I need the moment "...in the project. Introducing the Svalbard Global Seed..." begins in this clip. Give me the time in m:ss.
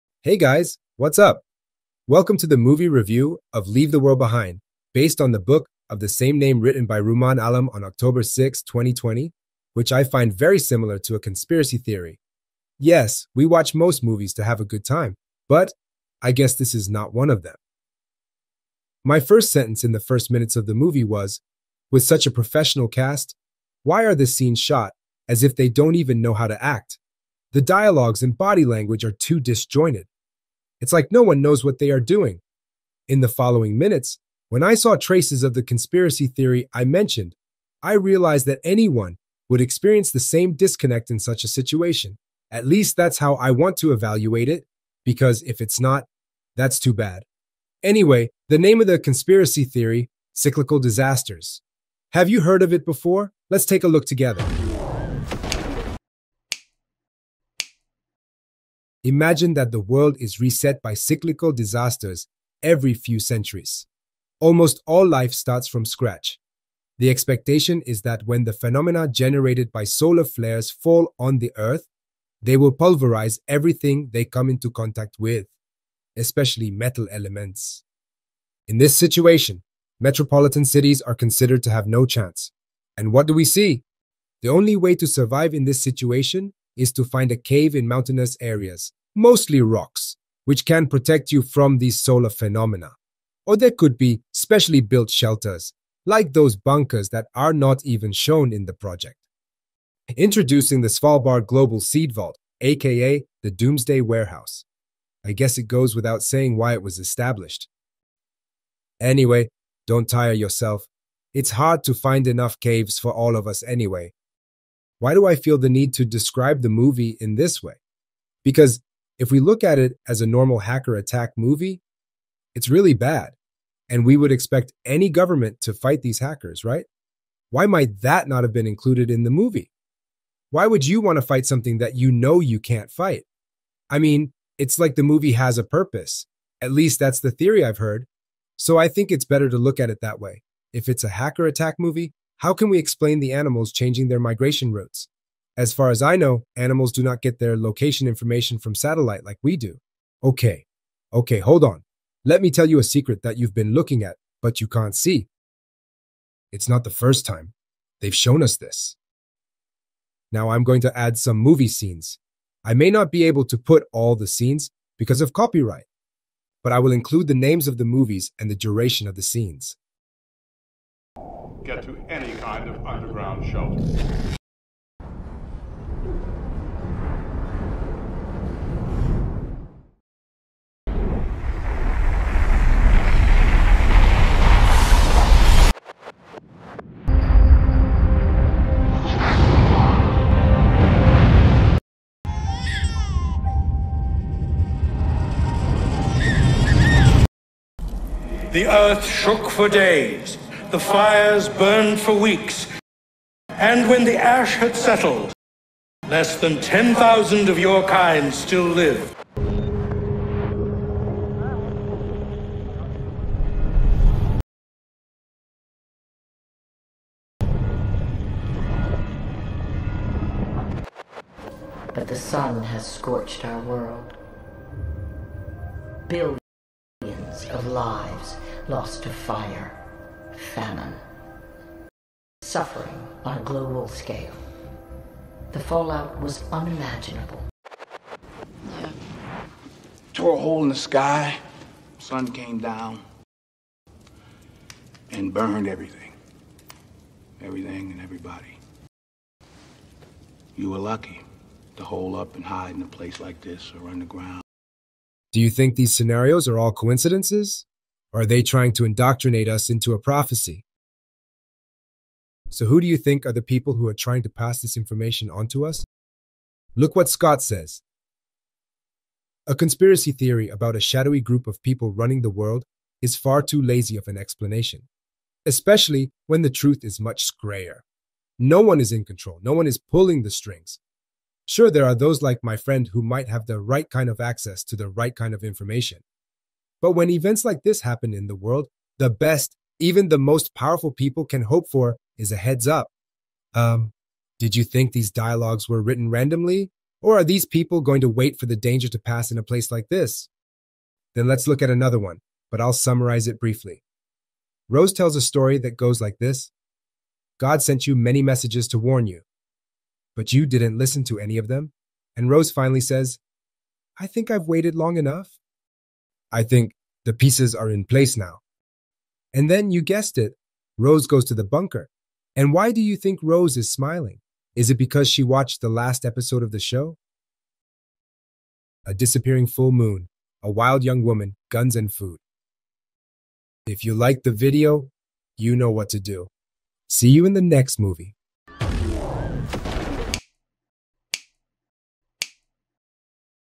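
1:38.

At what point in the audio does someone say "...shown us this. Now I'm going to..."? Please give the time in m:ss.
2:38.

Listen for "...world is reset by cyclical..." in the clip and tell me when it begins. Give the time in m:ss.
0:59.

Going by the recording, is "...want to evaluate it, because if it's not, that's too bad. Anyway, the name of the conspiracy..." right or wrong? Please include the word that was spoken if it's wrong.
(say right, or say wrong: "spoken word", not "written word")
right.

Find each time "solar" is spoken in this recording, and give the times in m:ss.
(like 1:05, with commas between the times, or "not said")
1:09, 1:31.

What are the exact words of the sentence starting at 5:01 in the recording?
Then let's look at another one, but I'll summarize it briefly.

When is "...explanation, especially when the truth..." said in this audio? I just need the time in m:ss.
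4:34.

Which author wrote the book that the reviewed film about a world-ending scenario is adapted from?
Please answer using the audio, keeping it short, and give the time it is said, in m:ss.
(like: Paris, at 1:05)
Rumaan Alam, at 0:07.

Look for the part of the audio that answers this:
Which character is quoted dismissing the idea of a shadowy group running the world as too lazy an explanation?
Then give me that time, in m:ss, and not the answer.
4:27.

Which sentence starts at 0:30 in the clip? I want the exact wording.
It's like no one knows what they are doing.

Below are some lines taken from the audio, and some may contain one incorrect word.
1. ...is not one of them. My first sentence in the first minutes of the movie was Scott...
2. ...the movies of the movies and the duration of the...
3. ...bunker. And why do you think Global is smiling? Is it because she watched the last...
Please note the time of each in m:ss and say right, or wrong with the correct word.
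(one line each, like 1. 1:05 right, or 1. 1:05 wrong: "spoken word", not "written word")
1. 0:16 wrong: "With", not "Scott"
2. 2:47 wrong: "names", not "movies"
3. 5:21 wrong: "Rose", not "Global".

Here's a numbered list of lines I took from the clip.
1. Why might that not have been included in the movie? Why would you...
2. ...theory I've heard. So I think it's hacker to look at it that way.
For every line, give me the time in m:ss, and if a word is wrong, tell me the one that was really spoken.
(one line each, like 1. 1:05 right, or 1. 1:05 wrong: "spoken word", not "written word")
1. 2:07 right
2. 2:17 wrong: "better", not "hacker".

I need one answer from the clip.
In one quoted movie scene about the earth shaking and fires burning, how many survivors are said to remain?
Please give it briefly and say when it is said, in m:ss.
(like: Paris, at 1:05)
less than 10,000, at 3:26.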